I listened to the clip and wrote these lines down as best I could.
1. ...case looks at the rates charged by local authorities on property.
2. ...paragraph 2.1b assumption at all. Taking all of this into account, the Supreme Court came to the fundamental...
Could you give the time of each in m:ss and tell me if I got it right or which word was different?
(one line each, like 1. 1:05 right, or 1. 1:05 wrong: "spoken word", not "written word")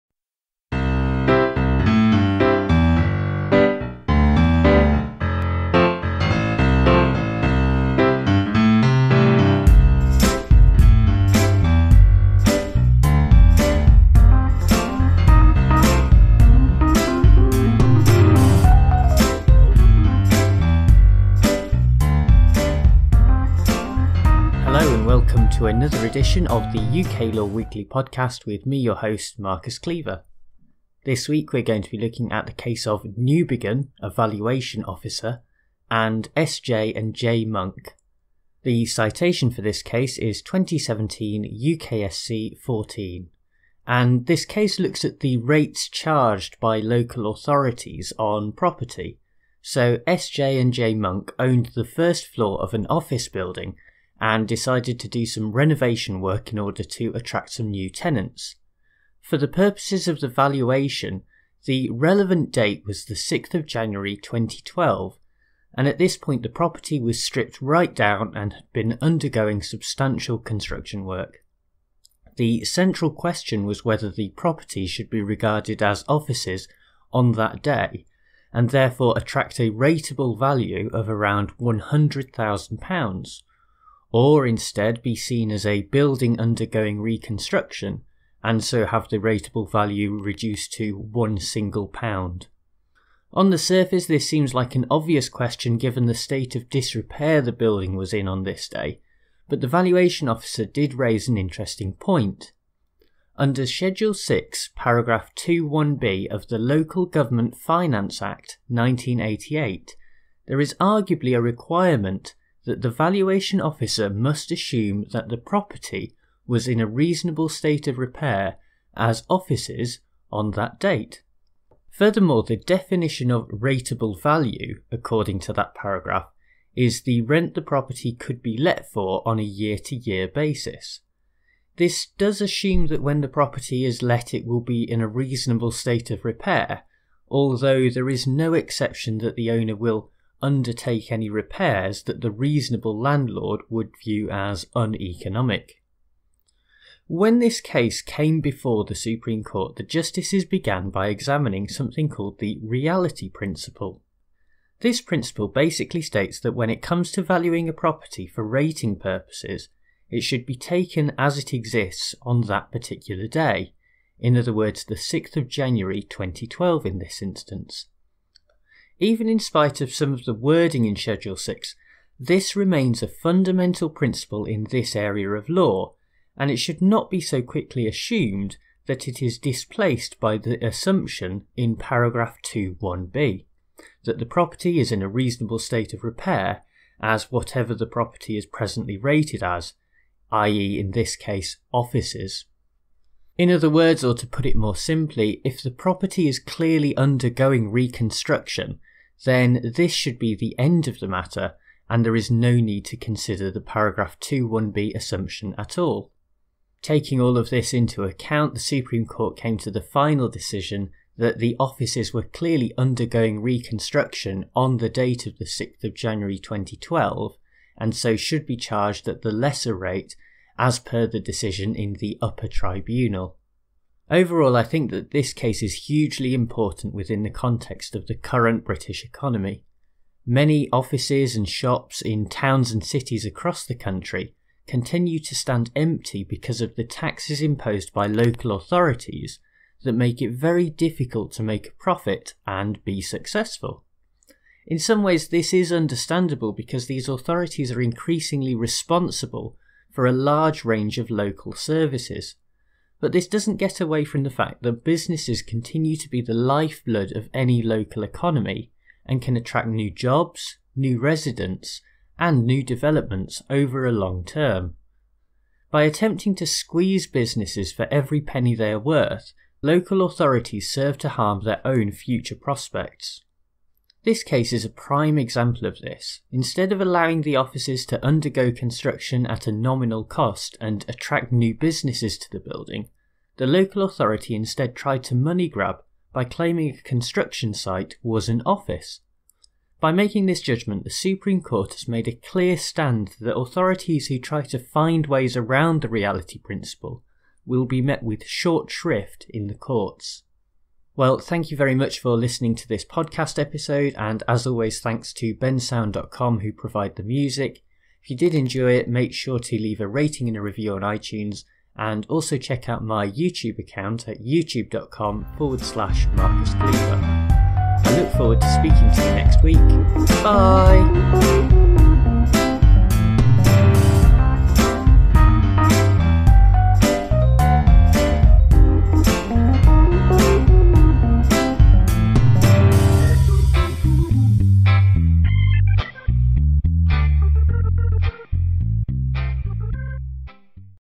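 1. 0:44 right
2. 3:23 wrong: "final", not "fundamental".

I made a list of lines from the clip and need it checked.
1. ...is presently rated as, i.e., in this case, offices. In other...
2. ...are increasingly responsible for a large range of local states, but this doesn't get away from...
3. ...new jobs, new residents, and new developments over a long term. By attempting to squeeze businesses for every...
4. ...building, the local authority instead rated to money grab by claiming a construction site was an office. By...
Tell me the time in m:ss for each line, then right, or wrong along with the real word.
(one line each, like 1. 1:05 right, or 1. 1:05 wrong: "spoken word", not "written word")
1. 3:08 right
2. 4:07 wrong: "services", not "states"
3. 4:19 right
4. 4:42 wrong: "tried", not "rated".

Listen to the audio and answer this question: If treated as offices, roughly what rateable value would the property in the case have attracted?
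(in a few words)
£100,000.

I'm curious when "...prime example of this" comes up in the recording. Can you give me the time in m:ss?
4:34.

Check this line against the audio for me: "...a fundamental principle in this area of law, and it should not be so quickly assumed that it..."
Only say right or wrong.
right.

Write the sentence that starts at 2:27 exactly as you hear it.
When this case came before the Supreme Court, the justices began by examining something called the reality principle.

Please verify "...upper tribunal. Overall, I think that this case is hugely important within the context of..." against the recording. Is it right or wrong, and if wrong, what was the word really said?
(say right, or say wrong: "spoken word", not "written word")
right.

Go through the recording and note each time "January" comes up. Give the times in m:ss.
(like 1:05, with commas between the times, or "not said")
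1:03, 2:45, 3:35.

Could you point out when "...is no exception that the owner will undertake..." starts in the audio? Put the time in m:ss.
2:18.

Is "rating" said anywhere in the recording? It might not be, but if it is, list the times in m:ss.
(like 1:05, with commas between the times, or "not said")
2:38, 5:09.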